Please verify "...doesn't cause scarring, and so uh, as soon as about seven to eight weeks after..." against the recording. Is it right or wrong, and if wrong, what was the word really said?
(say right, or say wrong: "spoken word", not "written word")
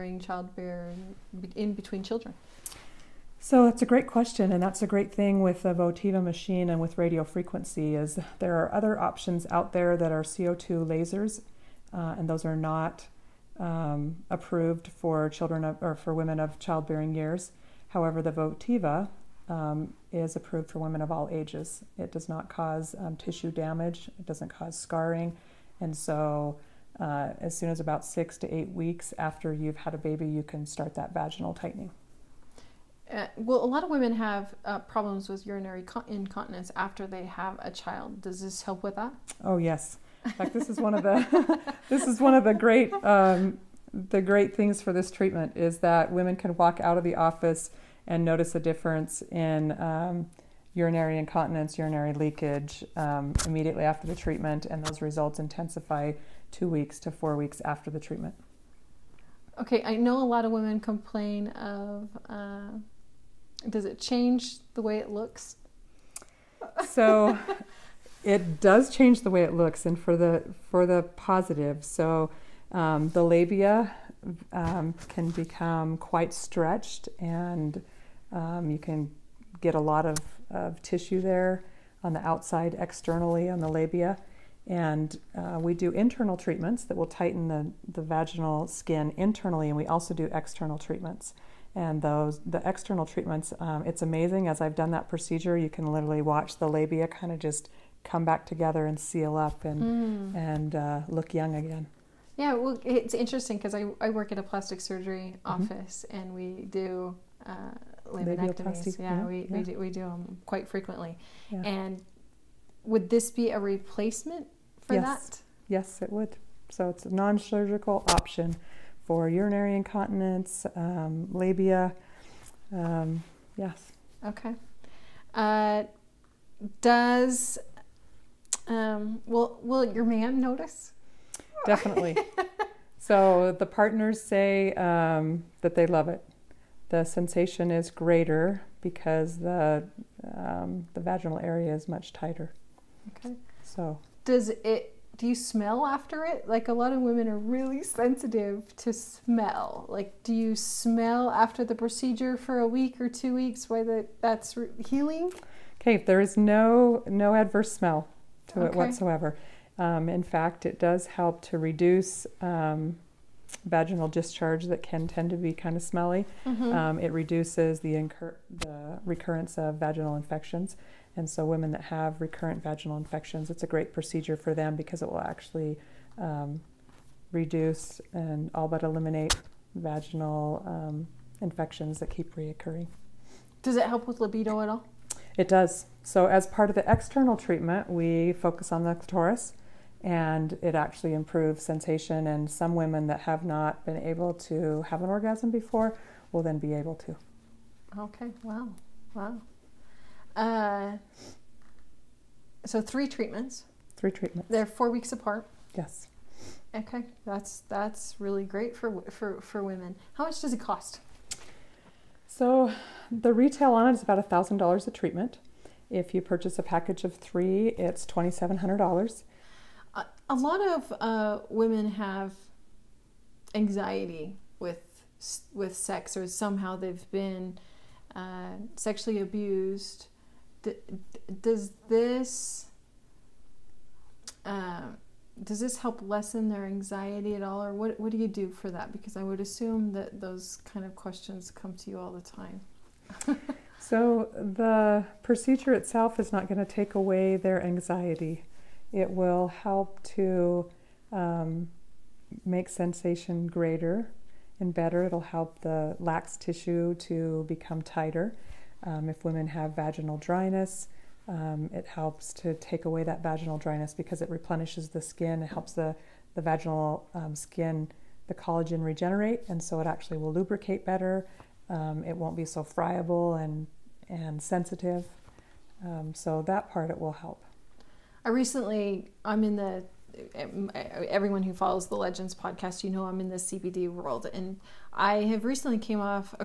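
wrong: "six", not "seven".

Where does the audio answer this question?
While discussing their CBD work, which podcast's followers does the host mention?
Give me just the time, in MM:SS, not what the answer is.
04:41.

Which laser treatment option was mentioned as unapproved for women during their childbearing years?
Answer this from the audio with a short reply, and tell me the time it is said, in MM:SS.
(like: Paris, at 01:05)
CO2 lasers, at 00:10.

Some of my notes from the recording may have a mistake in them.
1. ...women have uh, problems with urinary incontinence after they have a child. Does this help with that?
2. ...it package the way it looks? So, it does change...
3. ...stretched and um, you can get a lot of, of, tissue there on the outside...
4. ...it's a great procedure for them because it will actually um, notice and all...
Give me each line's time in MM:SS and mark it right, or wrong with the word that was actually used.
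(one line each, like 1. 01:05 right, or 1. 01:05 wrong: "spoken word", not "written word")
1. 00:33 right
2. 01:03 wrong: "change", not "package"
3. 01:16 right
4. 02:53 wrong: "reduce", not "notice".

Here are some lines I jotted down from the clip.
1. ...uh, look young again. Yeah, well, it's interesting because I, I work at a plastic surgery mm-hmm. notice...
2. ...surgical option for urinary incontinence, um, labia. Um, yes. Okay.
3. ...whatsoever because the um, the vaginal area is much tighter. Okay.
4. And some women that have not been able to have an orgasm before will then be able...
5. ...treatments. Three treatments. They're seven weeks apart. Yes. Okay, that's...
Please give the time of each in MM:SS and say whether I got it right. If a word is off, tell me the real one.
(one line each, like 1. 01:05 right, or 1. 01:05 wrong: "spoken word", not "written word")
1. 01:40 wrong: "office", not "notice"
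2. 01:57 right
3. 02:17 wrong: "greater", not "whatsoever"
4. 03:12 right
5. 03:23 wrong: "four", not "seven".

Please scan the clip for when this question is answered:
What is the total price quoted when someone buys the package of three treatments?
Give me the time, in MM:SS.
03:38.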